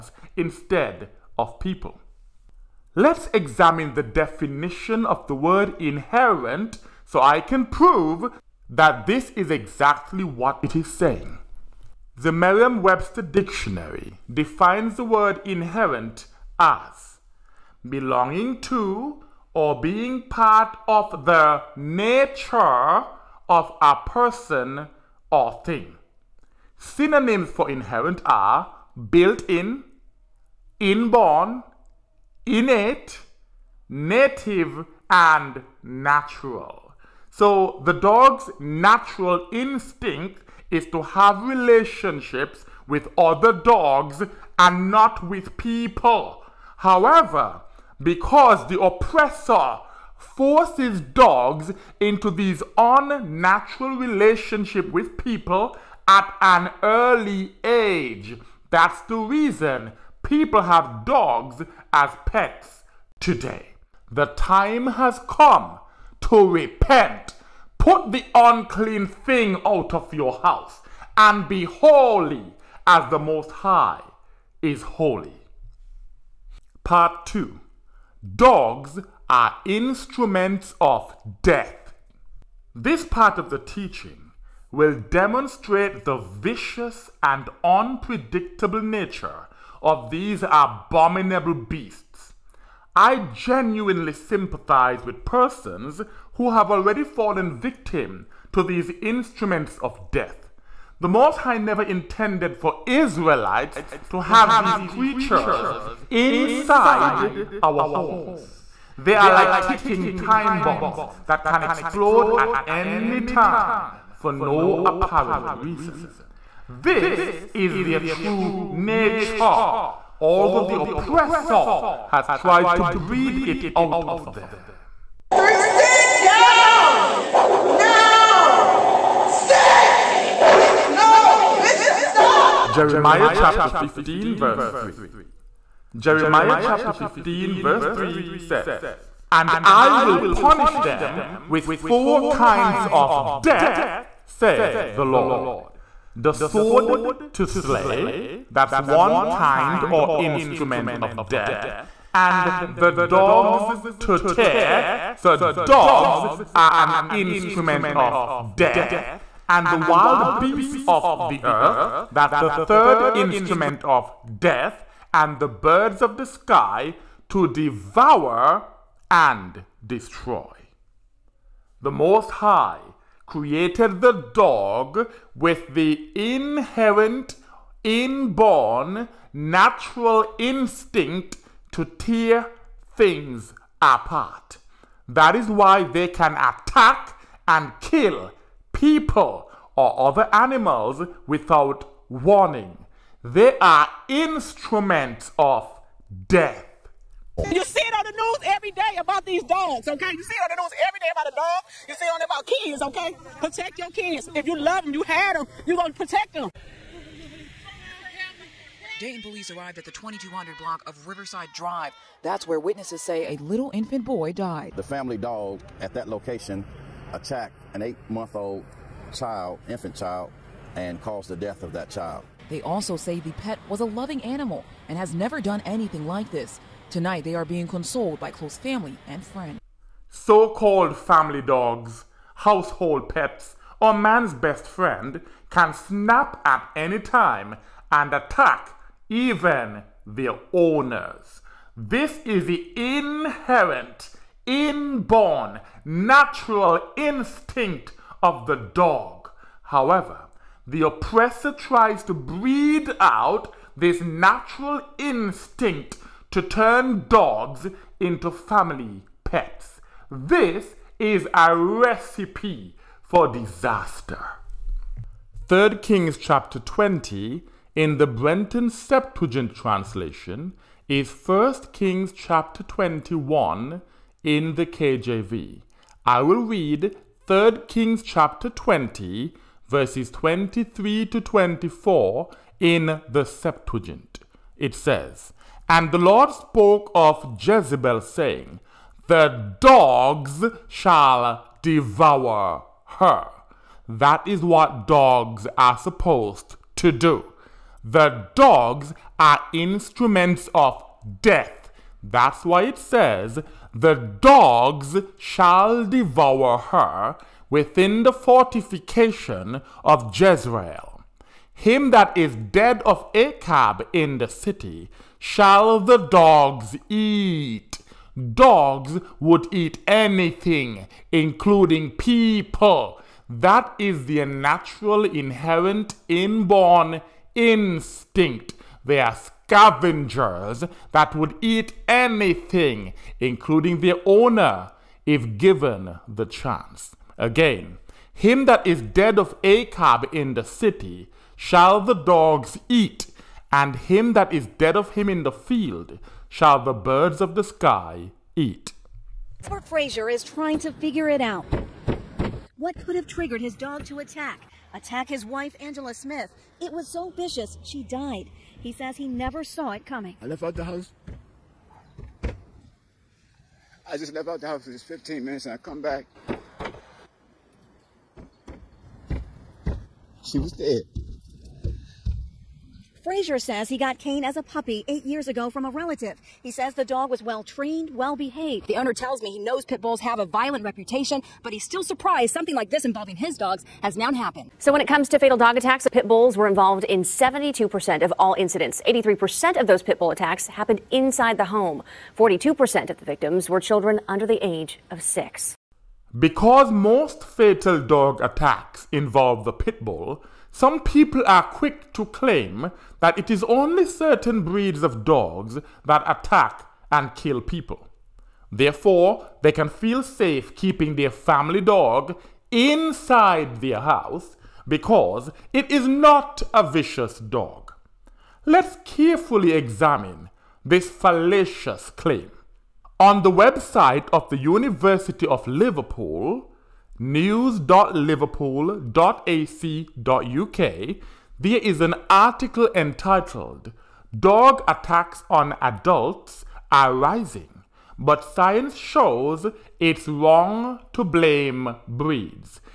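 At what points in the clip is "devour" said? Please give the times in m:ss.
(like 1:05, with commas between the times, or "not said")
2:47, 4:51, 5:05.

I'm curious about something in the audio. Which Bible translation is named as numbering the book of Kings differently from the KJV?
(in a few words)
Brenton Septuagint.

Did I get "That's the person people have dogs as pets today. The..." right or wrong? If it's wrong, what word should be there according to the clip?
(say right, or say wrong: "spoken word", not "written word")
wrong: "reason", not "person".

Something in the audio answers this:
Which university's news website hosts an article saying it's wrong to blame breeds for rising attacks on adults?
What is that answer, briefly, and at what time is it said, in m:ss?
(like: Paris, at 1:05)
University of Liverpool, at 7:04.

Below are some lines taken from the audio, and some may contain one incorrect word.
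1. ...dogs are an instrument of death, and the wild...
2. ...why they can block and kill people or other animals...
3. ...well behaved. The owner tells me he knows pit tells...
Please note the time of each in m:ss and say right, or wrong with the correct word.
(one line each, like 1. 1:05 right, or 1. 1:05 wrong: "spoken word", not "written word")
1. 2:35 right
2. 3:05 wrong: "attack", not "block"
3. 6:17 wrong: "bulls", not "tells".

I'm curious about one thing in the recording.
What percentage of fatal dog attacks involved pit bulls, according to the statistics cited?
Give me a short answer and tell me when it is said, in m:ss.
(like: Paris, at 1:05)
72%, at 6:27.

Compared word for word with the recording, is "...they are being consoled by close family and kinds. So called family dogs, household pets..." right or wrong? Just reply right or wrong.
wrong.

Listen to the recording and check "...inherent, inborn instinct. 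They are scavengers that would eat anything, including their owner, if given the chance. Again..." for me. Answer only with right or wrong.
right.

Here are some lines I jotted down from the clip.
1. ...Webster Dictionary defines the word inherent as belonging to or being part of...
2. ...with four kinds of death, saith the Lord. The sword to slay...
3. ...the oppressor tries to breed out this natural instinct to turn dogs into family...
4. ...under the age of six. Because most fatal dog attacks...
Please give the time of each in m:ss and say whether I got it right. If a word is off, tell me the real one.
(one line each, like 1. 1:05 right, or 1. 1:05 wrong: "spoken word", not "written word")
1. 0:12 right
2. 2:21 right
3. 4:10 right
4. 6:34 right.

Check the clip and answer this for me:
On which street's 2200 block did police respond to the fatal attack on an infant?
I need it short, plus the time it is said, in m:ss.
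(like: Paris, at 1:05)
Riverside Drive, at 3:31.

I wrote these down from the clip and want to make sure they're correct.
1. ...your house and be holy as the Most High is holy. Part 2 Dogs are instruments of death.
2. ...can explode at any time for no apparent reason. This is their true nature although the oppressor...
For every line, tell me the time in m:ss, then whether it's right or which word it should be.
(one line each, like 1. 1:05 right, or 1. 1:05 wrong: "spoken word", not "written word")
1. 1:10 right
2. 1:51 right.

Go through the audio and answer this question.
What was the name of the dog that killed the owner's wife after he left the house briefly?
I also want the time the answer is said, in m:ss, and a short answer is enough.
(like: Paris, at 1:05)
Kane, at 6:13.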